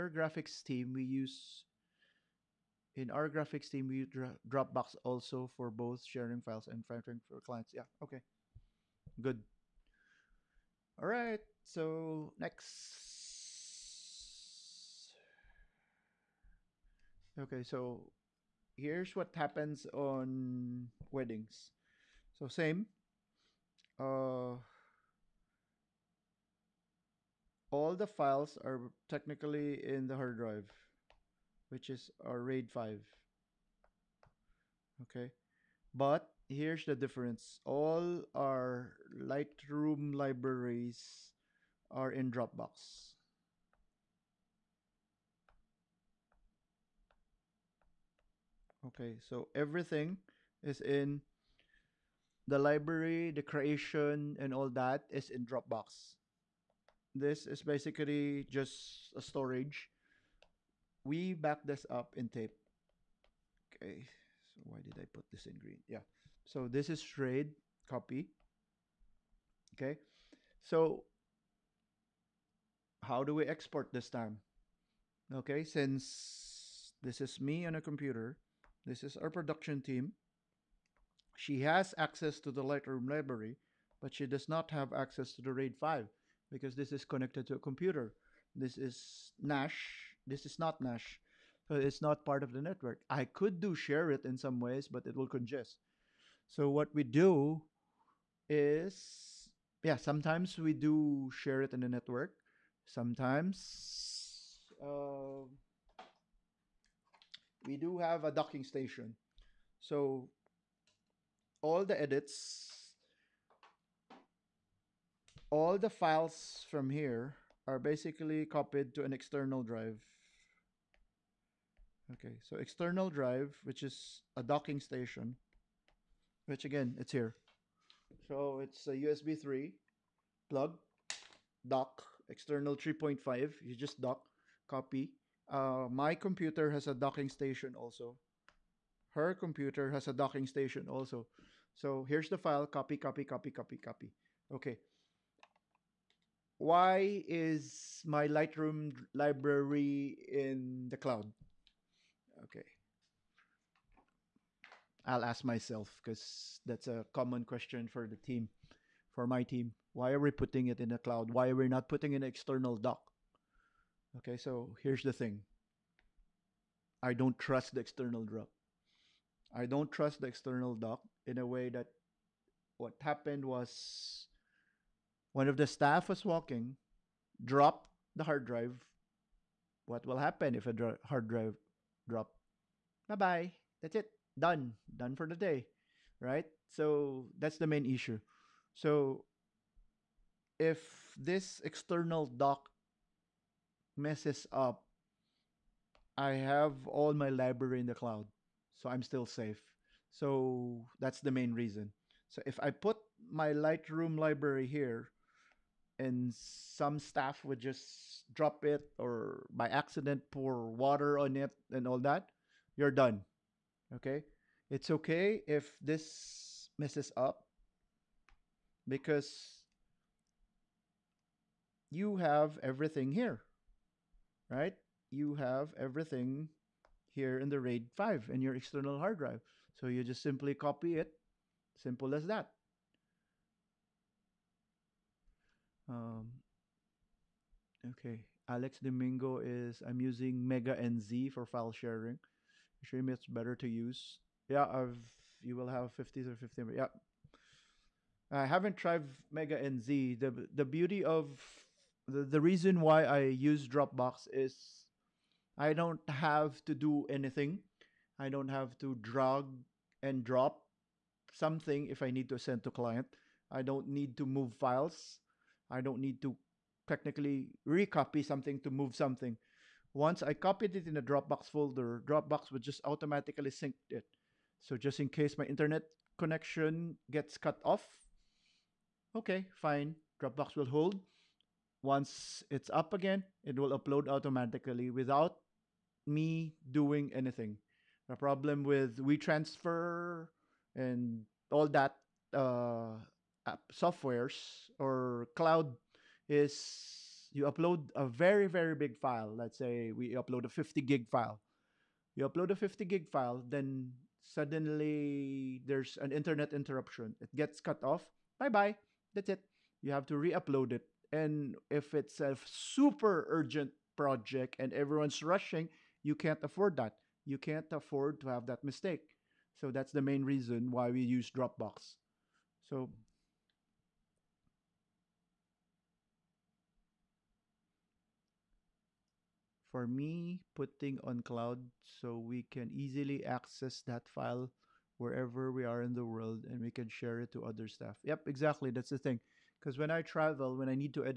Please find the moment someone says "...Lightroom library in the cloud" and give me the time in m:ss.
2:28.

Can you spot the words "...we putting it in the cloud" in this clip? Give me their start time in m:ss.
2:40.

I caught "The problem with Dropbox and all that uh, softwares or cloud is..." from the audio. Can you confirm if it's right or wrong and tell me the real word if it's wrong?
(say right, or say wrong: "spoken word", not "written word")
wrong: "WeTransfer", not "Dropbox".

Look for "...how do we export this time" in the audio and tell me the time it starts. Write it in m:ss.
1:13.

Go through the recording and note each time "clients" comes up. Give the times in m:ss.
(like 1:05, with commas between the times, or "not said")
0:07, 4:22.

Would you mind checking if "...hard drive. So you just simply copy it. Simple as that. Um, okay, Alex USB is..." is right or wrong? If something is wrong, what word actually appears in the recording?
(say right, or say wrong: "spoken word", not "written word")
wrong: "Domingo", not "USB".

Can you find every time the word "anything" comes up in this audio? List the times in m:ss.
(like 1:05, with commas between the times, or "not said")
4:17, 4:47.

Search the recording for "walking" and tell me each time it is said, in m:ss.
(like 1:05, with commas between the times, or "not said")
2:56.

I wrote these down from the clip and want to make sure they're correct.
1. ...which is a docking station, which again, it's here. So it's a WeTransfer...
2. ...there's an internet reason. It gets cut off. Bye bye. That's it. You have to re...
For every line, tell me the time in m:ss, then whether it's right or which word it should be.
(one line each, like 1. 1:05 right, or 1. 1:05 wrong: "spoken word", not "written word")
1. 2:03 wrong: "USB", not "WeTransfer"
2. 5:05 wrong: "interruption", not "reason".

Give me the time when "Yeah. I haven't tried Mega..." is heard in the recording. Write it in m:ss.
4:06.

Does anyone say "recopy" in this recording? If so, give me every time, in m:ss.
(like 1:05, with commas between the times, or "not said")
4:27.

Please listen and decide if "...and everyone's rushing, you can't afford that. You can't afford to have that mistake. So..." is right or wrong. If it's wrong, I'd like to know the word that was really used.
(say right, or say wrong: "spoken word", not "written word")
right.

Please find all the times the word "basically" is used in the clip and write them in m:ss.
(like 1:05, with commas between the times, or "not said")
0:57, 1:57.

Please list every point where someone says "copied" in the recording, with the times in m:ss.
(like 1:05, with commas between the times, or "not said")
1:58, 4:30.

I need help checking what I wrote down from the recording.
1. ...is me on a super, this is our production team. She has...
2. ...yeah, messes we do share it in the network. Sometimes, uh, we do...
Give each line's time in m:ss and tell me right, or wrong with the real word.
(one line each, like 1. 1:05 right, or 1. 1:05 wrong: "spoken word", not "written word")
1. 1:17 wrong: "computer", not "super"
2. 1:39 wrong: "sometimes", not "messes".